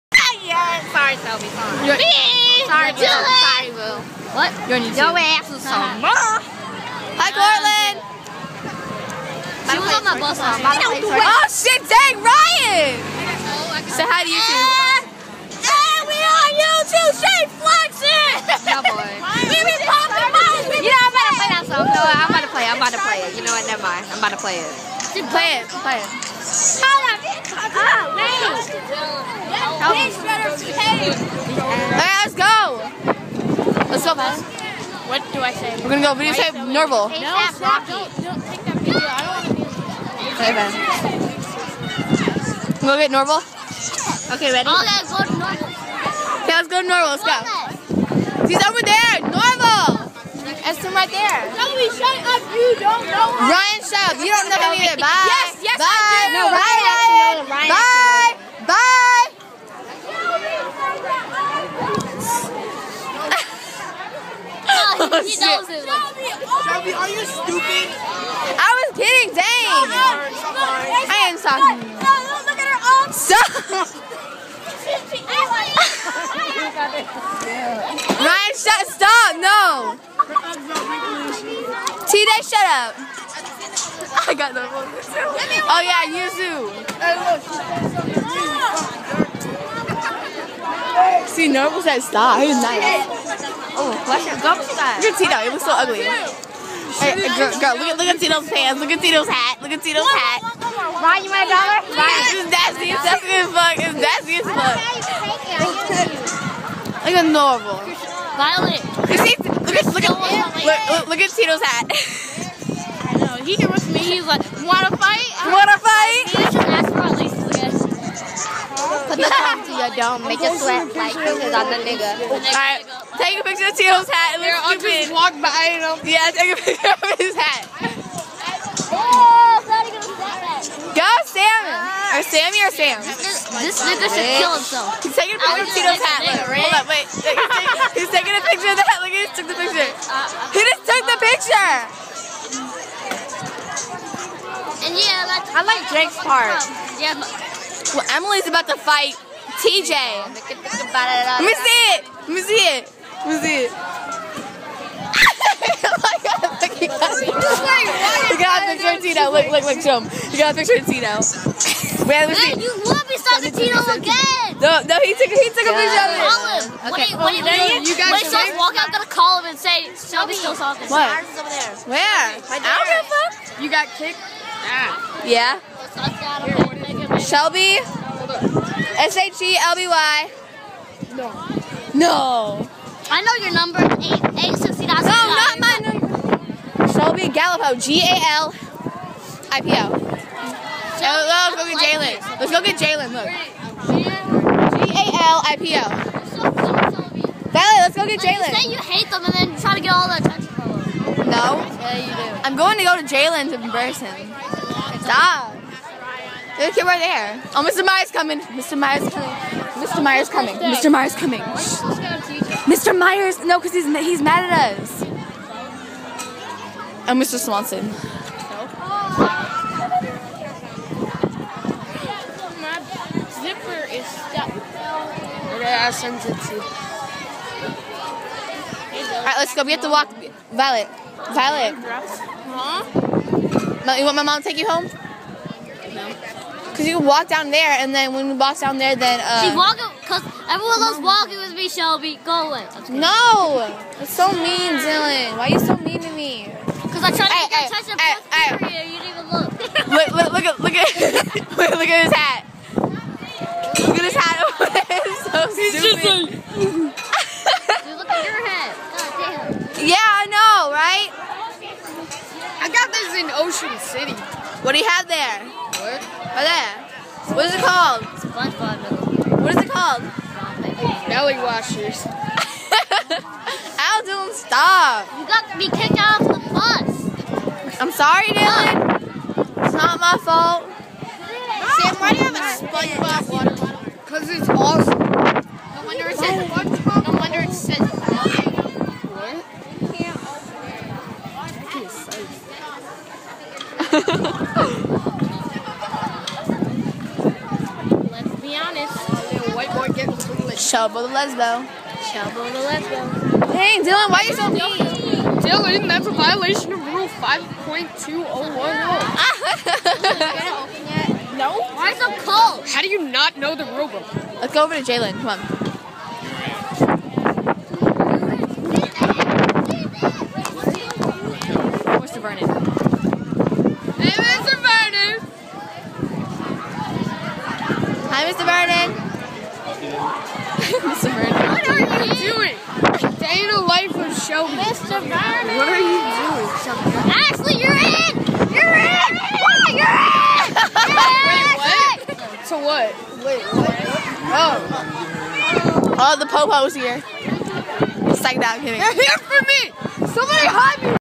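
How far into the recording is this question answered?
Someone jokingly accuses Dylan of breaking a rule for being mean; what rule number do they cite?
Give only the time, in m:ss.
5:06.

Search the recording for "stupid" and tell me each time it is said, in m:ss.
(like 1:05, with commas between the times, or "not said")
1:07, 2:04, 4:15.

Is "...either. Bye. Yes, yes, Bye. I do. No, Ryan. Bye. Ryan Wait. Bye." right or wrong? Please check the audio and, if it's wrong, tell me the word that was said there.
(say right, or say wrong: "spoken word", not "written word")
wrong: "Bye", not "Wait".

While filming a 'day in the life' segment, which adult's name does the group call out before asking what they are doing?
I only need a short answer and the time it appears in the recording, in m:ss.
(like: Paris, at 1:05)
Mr. Vernon, at 5:34.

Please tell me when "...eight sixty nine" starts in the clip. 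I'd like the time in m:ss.
3:04.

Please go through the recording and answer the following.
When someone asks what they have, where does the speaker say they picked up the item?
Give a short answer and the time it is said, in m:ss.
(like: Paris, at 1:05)
Ocean City, at 4:23.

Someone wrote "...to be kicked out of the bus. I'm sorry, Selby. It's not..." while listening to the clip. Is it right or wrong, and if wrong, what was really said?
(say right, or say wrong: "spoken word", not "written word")
wrong: "Dylan", not "Selby".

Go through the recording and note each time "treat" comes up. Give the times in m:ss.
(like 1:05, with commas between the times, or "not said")
not said.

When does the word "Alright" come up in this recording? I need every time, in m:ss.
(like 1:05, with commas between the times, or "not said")
0:30, 3:49.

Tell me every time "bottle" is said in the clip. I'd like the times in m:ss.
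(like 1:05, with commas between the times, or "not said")
4:43.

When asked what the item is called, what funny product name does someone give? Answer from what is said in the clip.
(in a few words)
Belly washers.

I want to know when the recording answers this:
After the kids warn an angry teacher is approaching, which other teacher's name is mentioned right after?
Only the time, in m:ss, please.
3:37.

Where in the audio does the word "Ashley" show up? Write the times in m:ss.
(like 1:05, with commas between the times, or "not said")
5:37.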